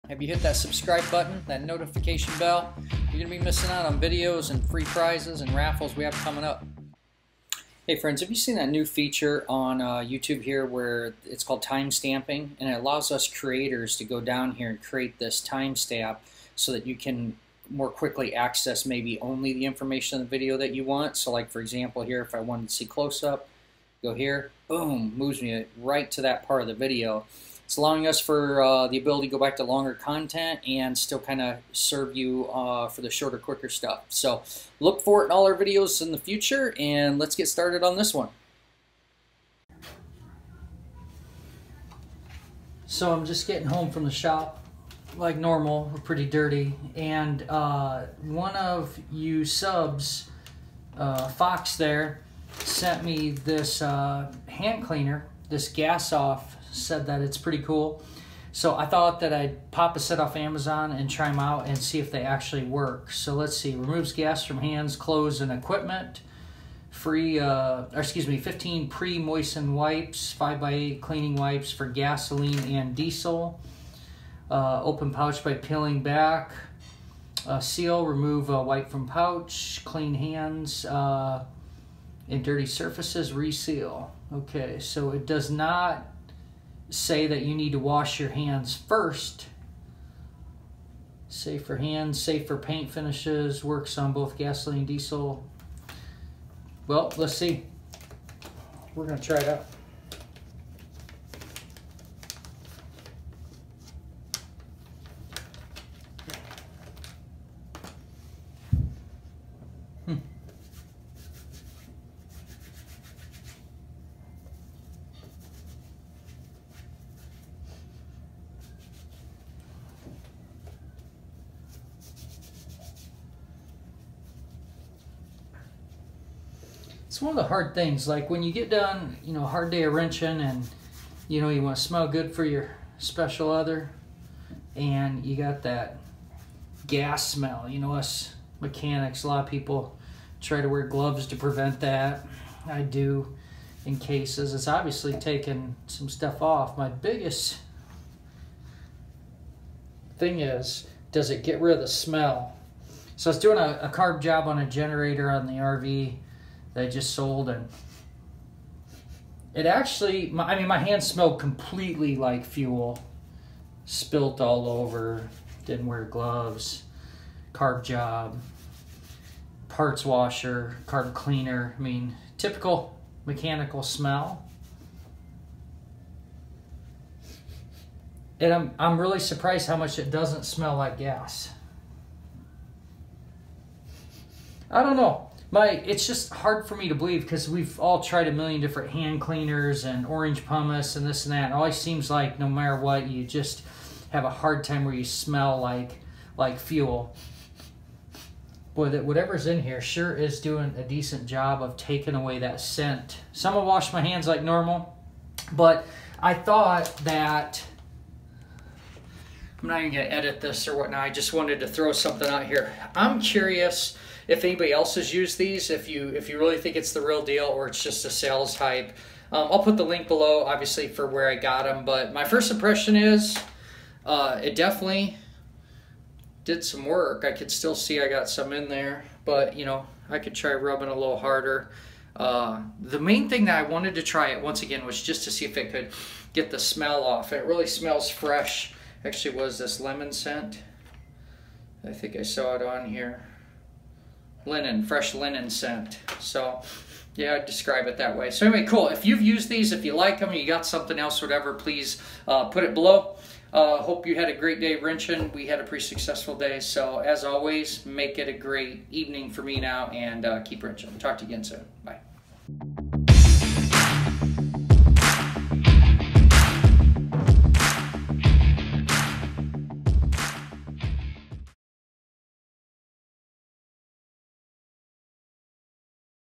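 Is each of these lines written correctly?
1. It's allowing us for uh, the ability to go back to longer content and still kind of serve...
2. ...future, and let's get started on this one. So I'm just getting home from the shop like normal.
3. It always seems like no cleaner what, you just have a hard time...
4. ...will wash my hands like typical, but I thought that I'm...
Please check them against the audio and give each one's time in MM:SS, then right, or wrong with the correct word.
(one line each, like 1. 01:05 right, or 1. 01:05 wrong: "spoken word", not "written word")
1. 00:27 right
2. 00:36 right
3. 03:11 wrong: "matter", not "cleaner"
4. 03:23 wrong: "normal", not "typical".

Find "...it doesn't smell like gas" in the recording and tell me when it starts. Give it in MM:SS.
02:59.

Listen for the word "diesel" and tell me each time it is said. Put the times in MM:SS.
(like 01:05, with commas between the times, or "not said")
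01:12, 01:34.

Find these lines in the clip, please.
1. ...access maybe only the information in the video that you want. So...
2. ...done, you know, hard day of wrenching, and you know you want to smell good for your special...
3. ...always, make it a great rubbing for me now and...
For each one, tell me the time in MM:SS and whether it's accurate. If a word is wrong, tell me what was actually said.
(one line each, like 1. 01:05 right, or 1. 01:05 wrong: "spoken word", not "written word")
1. 00:18 right
2. 02:08 right
3. 04:17 wrong: "evening", not "rubbing".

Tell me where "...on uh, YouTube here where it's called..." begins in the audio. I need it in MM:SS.
00:09.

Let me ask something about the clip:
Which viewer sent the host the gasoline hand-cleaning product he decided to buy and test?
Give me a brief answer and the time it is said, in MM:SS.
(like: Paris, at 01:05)
Foxtrot, at 00:51.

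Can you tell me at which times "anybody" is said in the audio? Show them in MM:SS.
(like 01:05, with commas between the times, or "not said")
03:34.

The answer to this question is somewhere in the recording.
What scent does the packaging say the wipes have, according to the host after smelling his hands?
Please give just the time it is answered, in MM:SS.
04:04.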